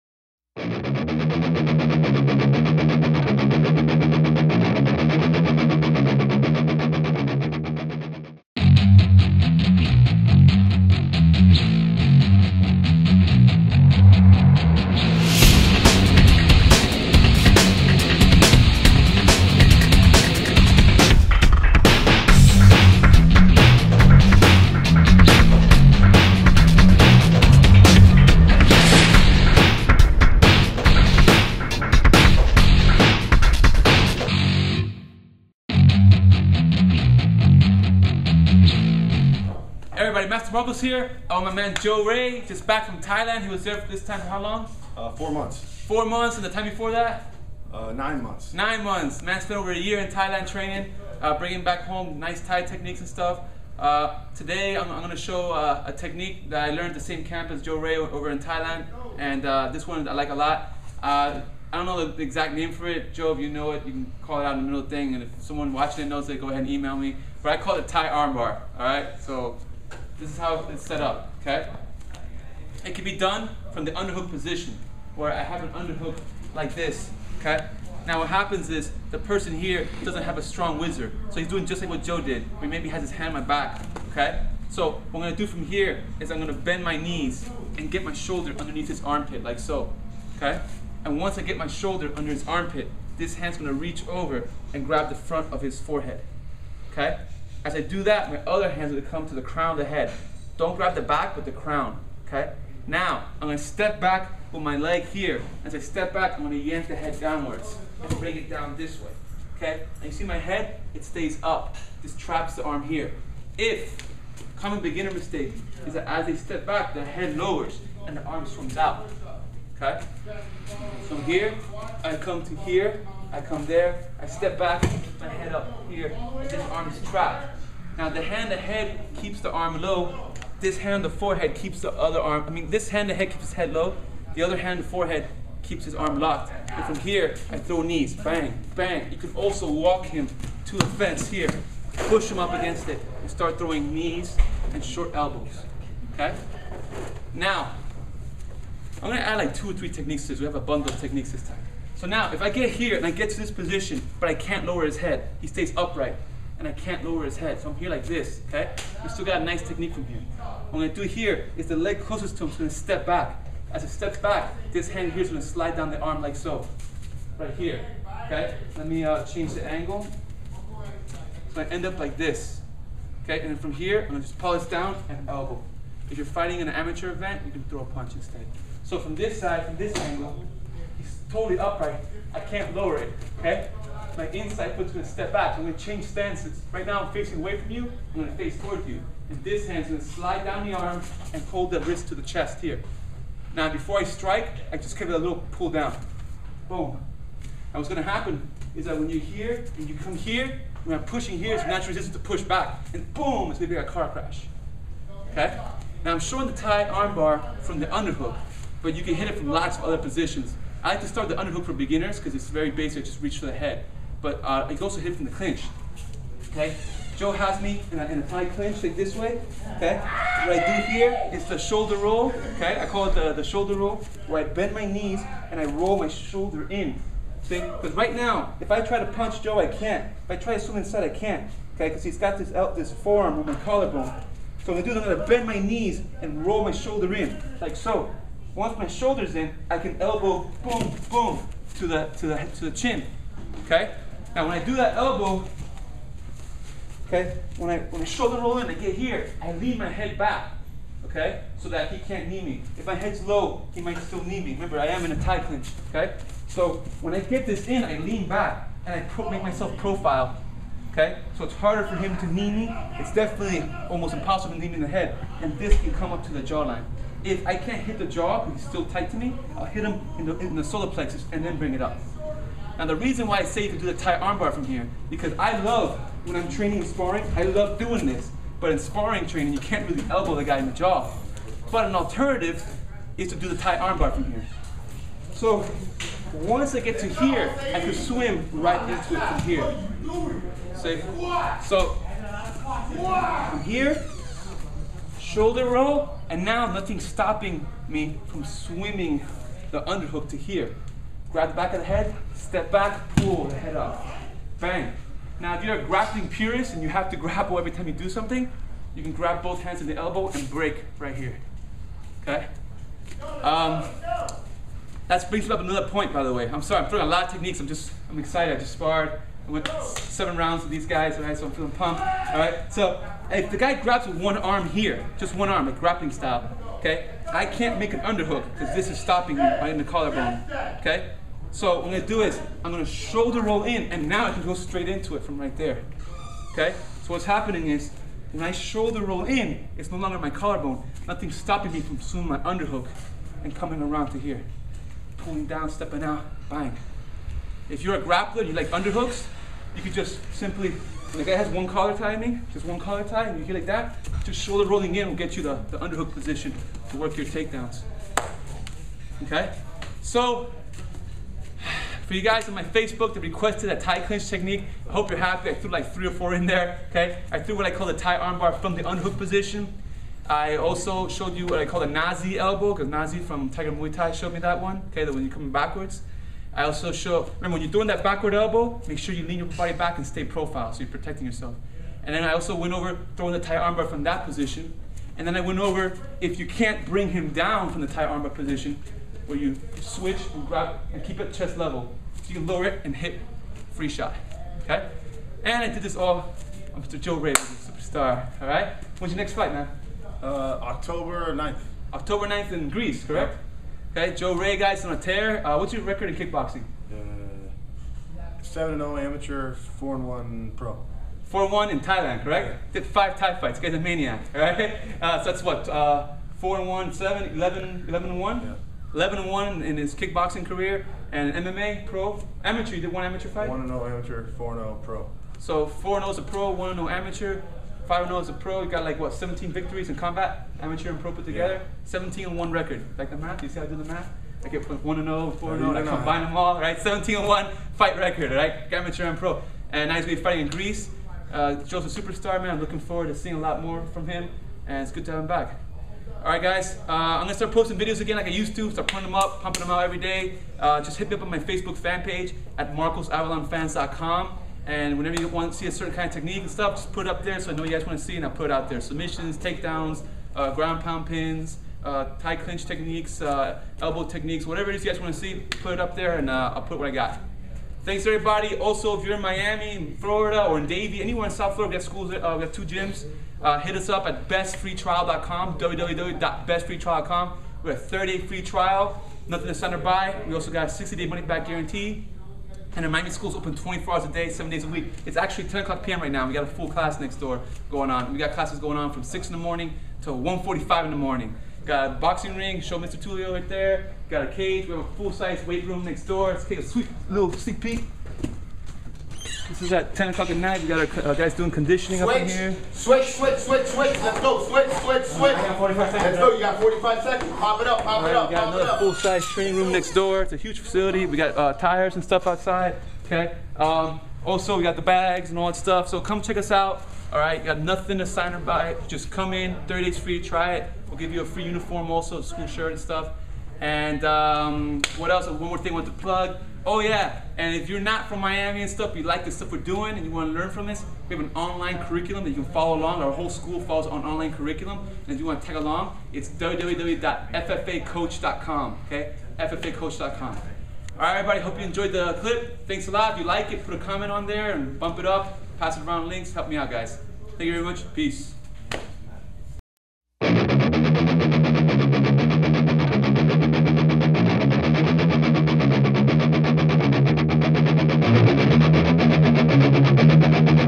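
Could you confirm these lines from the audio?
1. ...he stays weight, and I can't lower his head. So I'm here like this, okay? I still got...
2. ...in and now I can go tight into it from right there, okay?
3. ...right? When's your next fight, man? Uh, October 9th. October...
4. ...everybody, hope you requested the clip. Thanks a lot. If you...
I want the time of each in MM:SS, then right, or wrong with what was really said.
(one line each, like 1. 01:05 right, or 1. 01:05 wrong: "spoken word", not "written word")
1. 02:35 wrong: "upright", not "weight"
2. 05:33 wrong: "straight", not "tight"
3. 06:38 right
4. 09:01 wrong: "enjoyed", not "requested".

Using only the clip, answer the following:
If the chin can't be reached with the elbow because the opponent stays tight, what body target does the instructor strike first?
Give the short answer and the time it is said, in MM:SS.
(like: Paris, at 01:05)
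Solar plexus, at 04:30.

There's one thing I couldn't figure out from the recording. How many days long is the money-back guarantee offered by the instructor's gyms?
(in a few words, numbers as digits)
60.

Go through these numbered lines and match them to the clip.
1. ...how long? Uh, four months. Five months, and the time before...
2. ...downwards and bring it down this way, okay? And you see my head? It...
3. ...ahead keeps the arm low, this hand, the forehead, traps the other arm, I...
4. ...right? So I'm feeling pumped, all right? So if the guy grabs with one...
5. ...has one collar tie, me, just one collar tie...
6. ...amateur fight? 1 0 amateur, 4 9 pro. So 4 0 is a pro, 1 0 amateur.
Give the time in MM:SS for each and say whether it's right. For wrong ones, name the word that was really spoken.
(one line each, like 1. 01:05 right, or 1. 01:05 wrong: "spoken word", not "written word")
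1. 00:44 wrong: "Four", not "Five"
2. 01:47 right
3. 02:08 wrong: "keeps", not "traps"
4. 05:21 right
5. 05:51 right
6. 07:03 wrong: "0", not "9".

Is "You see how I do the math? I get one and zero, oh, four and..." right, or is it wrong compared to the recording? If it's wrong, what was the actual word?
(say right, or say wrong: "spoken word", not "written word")
right.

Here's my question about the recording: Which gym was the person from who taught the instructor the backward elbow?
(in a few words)
Tiger Muay Thai.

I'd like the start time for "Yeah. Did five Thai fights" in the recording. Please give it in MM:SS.
06:52.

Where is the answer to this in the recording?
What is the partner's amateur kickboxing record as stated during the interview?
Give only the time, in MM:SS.
06:48.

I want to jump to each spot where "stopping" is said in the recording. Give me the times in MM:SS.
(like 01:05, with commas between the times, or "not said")
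04:57, 05:28, 05:41.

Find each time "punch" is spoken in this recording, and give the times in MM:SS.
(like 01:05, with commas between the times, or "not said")
02:57, 03:49.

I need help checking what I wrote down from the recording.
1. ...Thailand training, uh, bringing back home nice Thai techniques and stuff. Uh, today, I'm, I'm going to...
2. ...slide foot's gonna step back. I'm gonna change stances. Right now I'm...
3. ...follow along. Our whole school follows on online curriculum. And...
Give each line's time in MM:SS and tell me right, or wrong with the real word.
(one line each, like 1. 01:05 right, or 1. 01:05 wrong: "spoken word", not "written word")
1. 00:50 right
2. 03:04 wrong: "inside", not "slide"
3. 08:52 right.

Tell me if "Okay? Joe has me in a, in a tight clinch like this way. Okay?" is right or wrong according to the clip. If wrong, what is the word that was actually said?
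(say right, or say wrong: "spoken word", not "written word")
right.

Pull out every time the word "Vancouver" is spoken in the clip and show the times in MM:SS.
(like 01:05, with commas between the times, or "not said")
not said.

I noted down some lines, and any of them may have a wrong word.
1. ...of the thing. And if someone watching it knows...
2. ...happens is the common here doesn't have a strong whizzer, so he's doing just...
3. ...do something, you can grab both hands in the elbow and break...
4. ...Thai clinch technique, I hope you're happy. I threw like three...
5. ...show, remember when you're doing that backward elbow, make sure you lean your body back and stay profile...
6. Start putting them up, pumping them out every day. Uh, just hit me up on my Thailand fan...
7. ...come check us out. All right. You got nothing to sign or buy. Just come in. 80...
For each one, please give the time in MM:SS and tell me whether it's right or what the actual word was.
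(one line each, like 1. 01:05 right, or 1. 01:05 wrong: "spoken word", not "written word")
1. 01:04 right
2. 01:18 wrong: "person", not "common"
3. 05:07 right
4. 06:03 right
5. 06:16 right
6. 07:28 wrong: "Facebook", not "Thailand"
7. 08:35 wrong: "30", not "80".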